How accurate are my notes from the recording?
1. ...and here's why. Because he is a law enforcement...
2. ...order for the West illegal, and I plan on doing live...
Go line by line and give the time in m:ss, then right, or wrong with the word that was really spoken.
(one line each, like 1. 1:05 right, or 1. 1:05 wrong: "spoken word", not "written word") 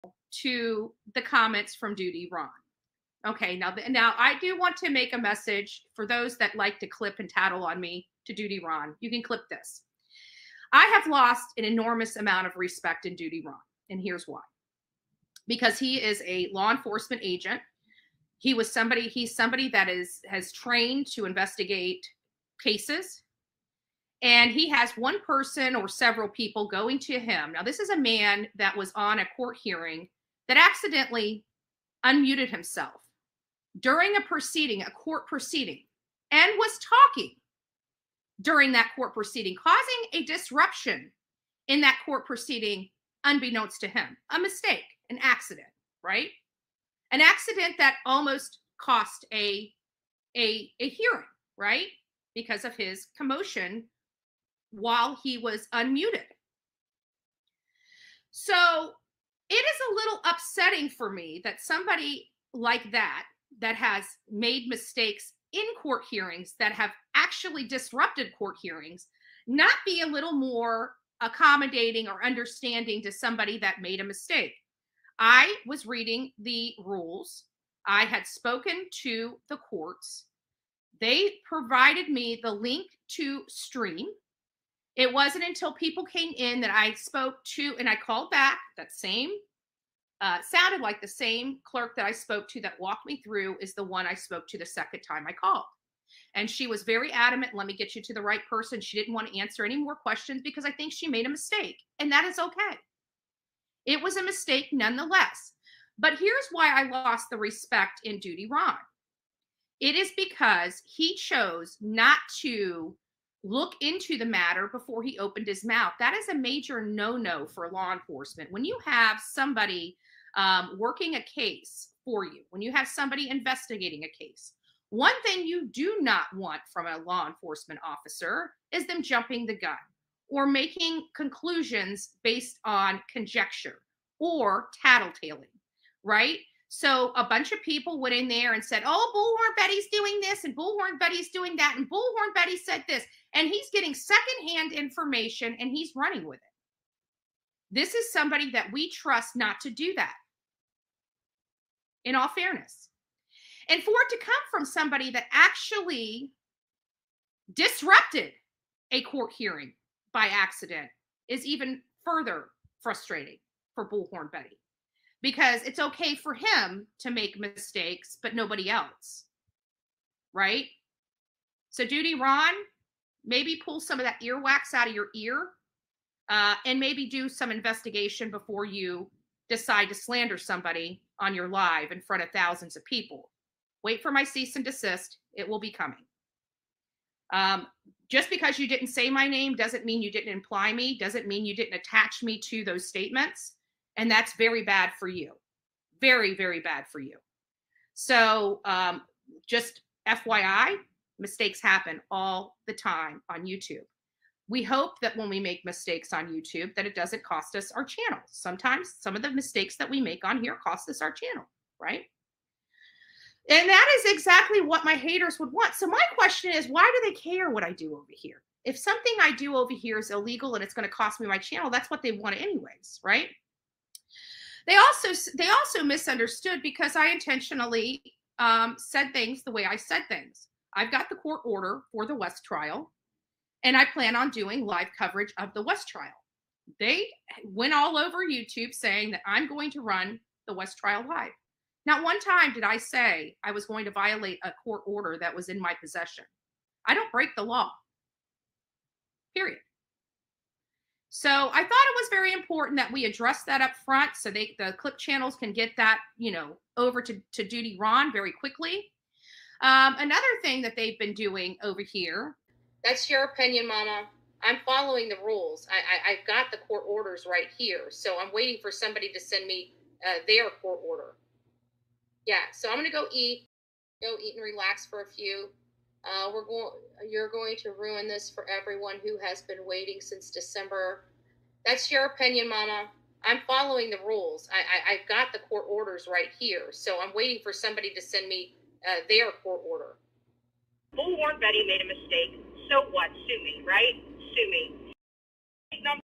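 1. 0:13 right
2. 3:51 wrong: "trial", not "illegal".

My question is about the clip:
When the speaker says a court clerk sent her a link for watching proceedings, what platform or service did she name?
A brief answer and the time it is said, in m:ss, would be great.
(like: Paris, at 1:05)
Stream, at 1:23.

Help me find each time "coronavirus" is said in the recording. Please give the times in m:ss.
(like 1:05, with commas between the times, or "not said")
not said.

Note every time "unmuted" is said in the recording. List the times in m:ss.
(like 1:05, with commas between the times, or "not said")
0:32, 0:55.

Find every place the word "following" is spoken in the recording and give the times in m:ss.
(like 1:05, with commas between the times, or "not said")
4:24, 4:43.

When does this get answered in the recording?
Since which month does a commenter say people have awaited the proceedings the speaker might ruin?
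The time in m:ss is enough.
4:40.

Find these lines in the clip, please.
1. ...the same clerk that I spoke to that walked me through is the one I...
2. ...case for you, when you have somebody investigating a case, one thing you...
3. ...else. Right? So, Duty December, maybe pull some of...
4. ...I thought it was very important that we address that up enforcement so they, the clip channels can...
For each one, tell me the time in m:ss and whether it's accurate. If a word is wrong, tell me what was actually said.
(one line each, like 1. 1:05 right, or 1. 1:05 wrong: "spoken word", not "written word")
1. 1:31 right
2. 2:01 right
3. 2:48 wrong: "Ron", not "December"
4. 4:11 wrong: "front", not "enforcement".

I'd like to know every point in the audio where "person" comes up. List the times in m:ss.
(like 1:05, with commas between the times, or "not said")
0:25, 1:38.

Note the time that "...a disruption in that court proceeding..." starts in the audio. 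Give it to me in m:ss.
0:40.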